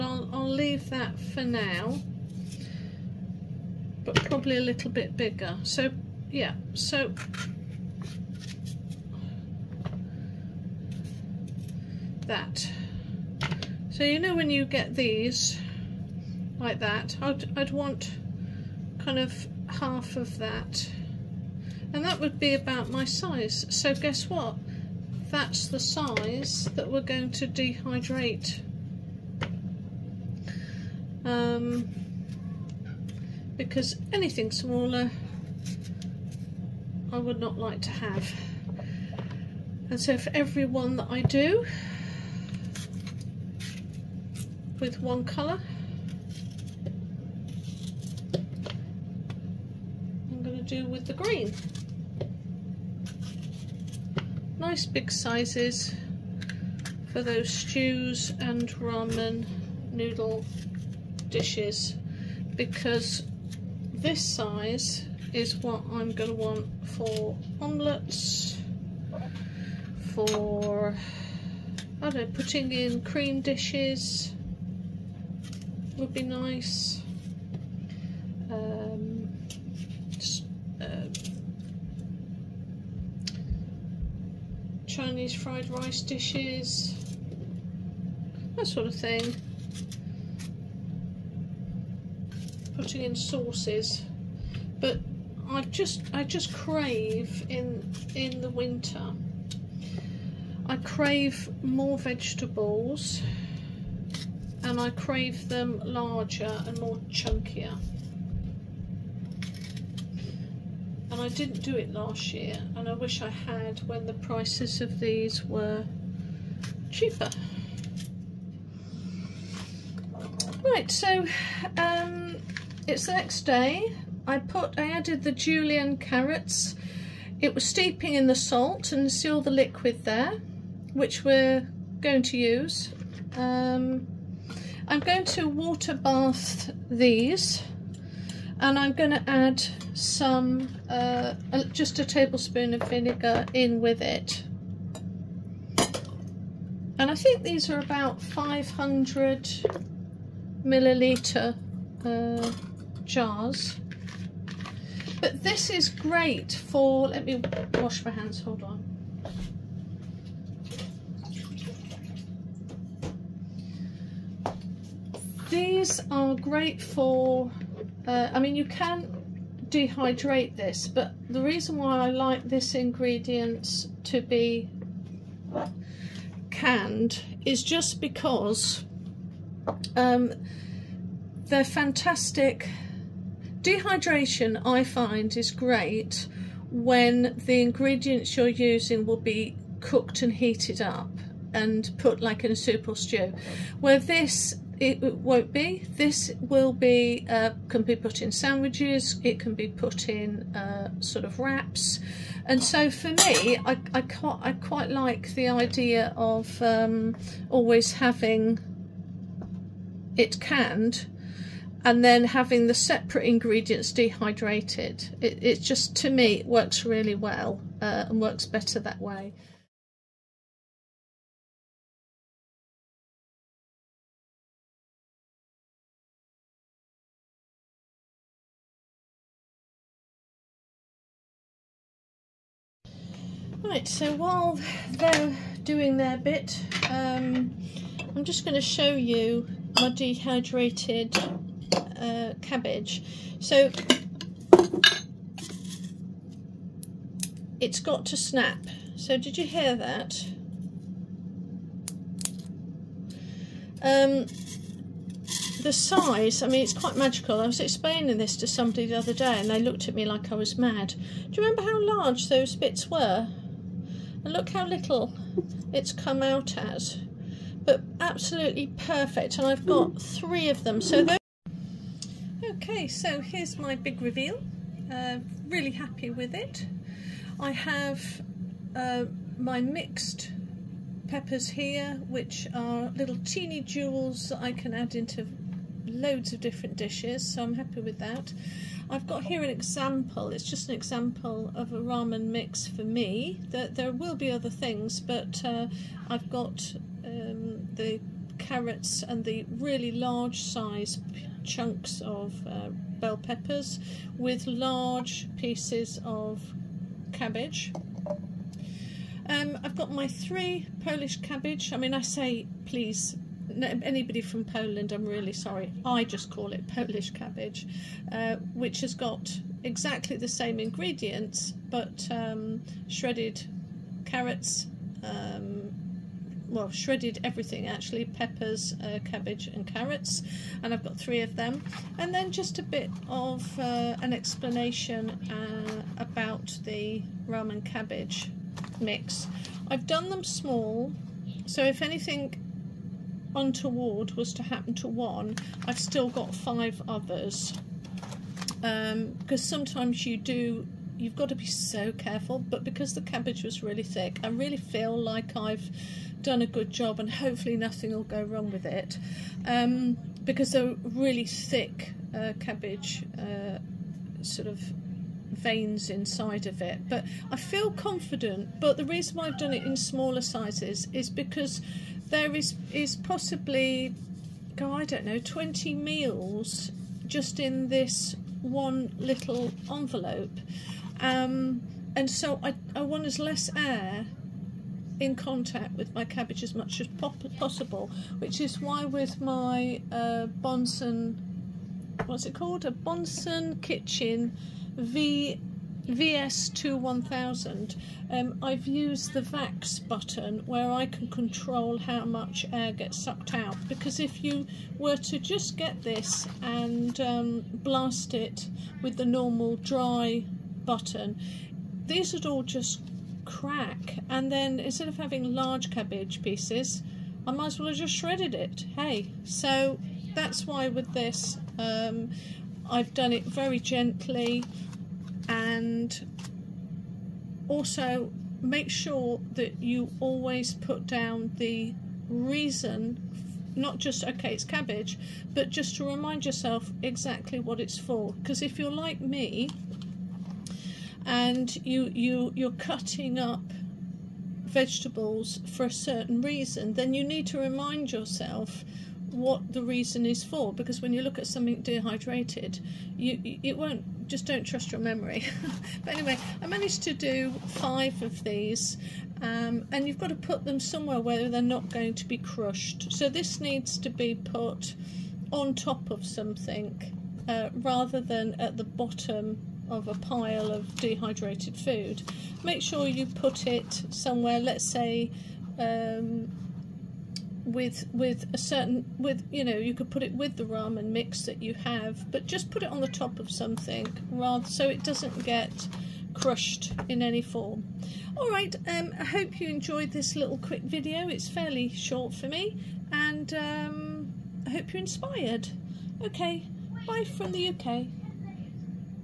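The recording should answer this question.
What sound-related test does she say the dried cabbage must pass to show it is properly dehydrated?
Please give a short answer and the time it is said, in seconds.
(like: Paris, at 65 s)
snap, at 248 s.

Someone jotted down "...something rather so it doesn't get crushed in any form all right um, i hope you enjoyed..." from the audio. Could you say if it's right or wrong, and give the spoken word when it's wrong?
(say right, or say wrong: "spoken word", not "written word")
right.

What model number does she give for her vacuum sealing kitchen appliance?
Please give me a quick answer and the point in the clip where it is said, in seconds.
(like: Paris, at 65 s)
VS21000, at 395 s.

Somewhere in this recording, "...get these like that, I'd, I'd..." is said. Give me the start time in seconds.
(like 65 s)
14 s.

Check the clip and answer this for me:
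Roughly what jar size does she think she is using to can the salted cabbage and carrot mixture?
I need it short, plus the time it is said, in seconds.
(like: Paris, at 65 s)
500 milliliters, at 148 s.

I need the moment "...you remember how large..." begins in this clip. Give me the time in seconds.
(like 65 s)
261 s.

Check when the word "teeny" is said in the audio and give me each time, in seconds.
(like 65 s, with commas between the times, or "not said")
283 s.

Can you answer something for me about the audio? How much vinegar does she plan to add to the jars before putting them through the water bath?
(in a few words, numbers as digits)
a tablespoon.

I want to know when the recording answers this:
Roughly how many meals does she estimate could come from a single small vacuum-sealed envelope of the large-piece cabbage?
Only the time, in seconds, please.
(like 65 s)
375 s.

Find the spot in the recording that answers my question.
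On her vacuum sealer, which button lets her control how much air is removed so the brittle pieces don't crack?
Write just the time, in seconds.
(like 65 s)
399 s.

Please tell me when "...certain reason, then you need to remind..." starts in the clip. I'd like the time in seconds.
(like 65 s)
445 s.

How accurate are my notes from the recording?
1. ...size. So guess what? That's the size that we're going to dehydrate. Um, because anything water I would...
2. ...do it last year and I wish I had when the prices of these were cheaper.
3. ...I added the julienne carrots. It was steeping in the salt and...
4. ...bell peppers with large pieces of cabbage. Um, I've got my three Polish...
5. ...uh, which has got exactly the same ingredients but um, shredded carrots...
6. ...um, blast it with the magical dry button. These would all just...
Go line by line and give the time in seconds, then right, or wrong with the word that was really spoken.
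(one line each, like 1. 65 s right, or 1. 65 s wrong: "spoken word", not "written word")
1. 23 s wrong: "smaller", not "water"
2. 111 s right
3. 124 s right
4. 302 s right
5. 318 s right
6. 407 s wrong: "normal", not "magical".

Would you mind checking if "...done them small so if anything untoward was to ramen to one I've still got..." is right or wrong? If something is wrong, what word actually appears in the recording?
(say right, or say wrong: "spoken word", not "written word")
wrong: "happen", not "ramen".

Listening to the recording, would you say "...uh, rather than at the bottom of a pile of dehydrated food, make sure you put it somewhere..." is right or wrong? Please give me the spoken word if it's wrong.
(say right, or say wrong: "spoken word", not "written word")
right.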